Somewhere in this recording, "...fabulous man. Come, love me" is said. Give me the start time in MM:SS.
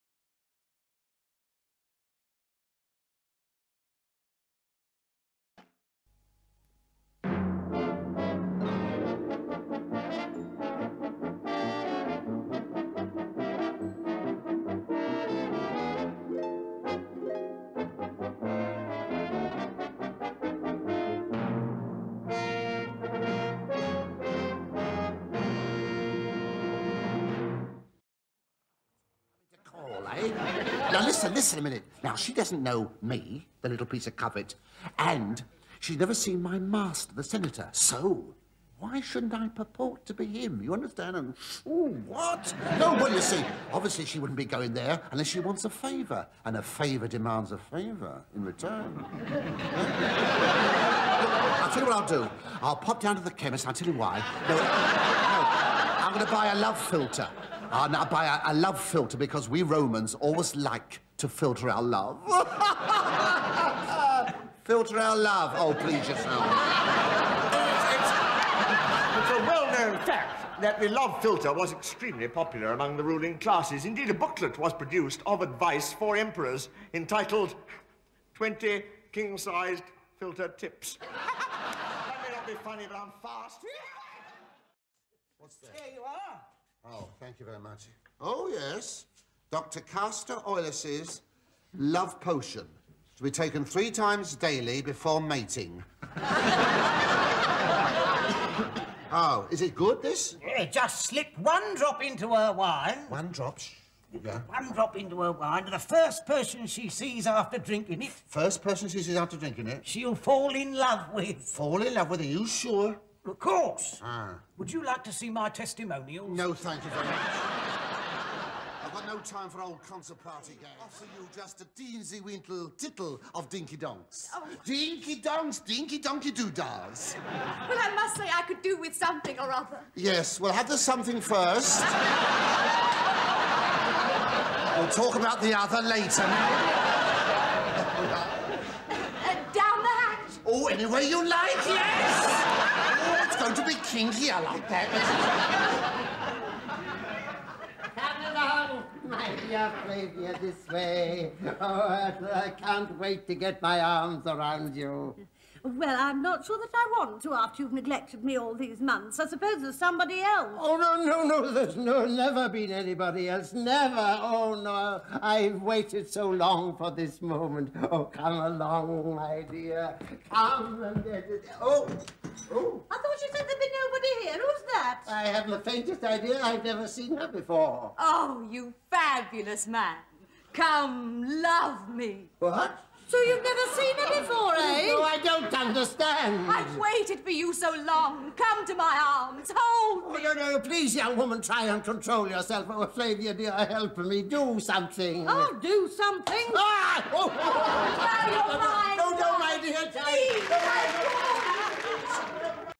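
02:58.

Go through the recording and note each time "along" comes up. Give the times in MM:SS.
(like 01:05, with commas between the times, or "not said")
02:28, 02:48.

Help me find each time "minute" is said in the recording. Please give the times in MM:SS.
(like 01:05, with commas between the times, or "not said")
00:31.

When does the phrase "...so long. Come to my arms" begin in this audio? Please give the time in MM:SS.
03:07.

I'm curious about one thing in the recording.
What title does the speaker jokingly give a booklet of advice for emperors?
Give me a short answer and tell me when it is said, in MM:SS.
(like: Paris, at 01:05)
20 King-Sized Filter Tips, at 01:18.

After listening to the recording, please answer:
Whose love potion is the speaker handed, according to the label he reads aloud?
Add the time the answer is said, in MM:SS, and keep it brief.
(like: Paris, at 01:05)
Dr. 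Castor Oiles, at 01:29.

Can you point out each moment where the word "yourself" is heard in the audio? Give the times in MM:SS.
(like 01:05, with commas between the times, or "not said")
01:06, 03:12.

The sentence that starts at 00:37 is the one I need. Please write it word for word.
So, why shouldn't I purport to be him?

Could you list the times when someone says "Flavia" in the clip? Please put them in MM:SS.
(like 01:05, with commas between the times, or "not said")
02:29, 03:12.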